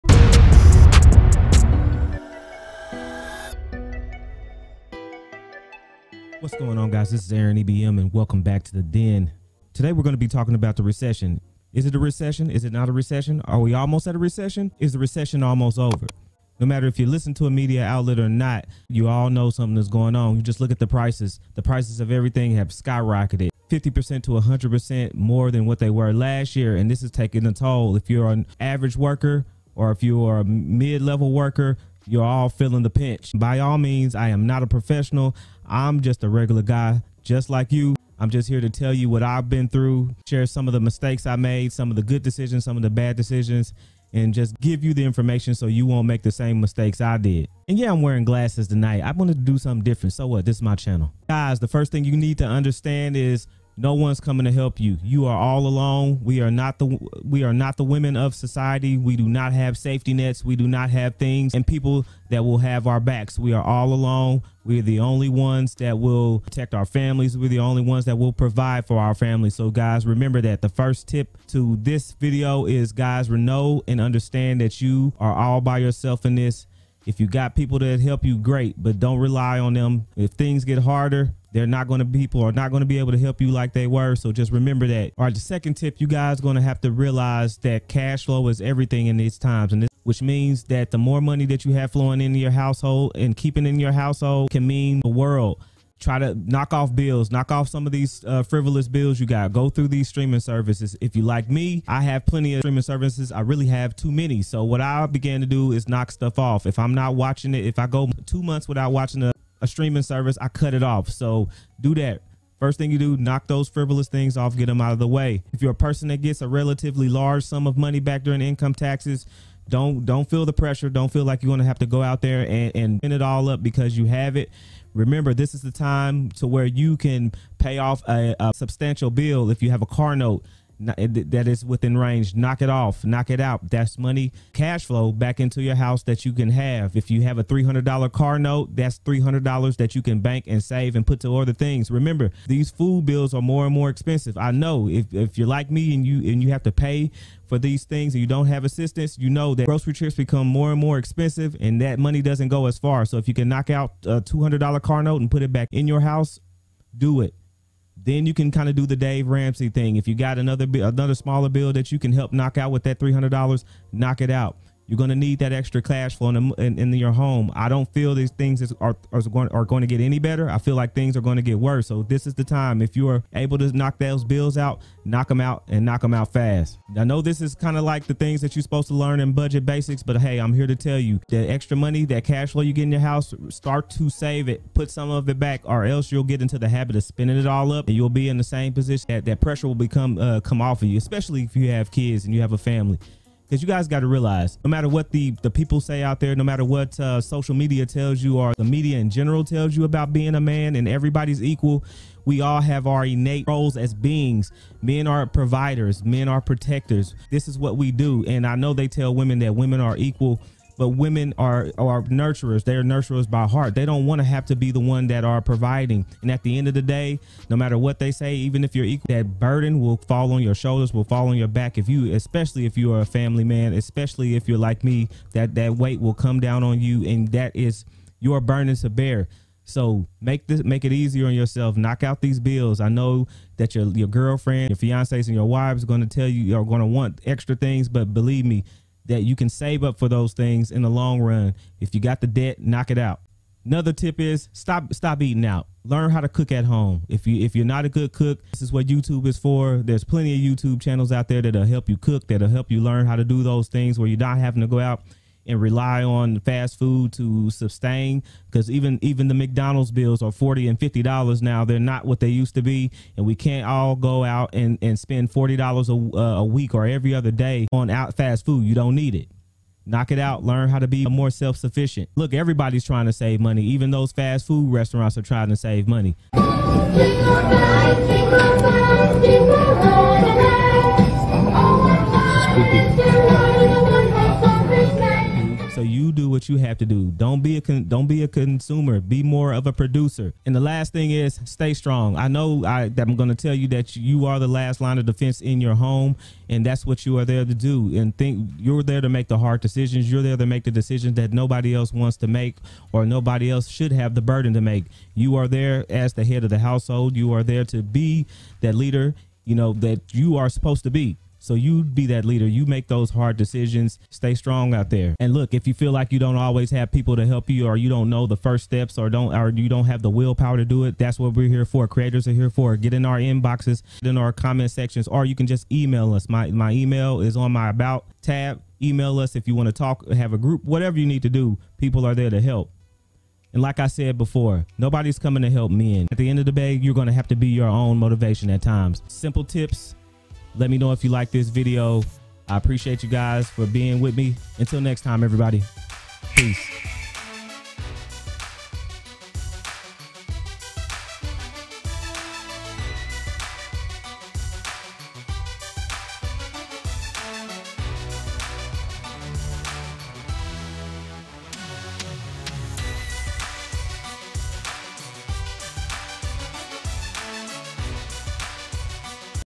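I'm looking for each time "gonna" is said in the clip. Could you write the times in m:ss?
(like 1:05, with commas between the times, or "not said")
2:01.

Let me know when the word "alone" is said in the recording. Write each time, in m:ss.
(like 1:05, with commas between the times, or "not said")
0:55, 1:03.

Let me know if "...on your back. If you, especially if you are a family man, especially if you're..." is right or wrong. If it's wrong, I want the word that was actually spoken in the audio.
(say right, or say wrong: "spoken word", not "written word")
right.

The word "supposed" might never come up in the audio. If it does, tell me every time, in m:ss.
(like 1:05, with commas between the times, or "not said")
2:58, 5:10.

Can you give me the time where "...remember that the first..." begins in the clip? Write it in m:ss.
1:10.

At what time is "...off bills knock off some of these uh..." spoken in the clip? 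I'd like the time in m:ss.
1:36.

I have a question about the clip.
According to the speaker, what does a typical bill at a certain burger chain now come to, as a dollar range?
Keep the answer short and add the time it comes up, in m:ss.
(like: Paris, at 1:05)
$40 and $50, at 4:20.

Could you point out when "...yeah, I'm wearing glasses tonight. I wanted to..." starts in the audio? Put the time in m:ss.
0:47.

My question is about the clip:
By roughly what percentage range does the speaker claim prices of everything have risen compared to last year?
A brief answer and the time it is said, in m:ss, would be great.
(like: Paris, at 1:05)
50% to 100%, at 0:23.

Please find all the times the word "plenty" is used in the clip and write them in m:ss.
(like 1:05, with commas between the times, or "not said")
1:42, 4:10.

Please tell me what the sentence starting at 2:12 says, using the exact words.
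Knock it off, knock it out.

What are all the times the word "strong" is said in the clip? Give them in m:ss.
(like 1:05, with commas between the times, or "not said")
4:51, 5:14.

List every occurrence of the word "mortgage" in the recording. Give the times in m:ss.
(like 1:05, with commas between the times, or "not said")
not said.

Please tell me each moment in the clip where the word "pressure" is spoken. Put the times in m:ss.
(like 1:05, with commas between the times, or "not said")
2:00, 3:09.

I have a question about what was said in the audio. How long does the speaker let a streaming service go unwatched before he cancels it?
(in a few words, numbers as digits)
2 months.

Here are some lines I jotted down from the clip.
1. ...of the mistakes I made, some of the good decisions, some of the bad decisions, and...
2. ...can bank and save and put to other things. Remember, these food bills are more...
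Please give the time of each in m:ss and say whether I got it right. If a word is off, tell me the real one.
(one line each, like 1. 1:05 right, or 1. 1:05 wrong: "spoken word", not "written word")
1. 0:40 right
2. 2:20 right.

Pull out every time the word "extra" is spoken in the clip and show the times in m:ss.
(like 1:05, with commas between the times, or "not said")
2:45, 3:01, 3:57.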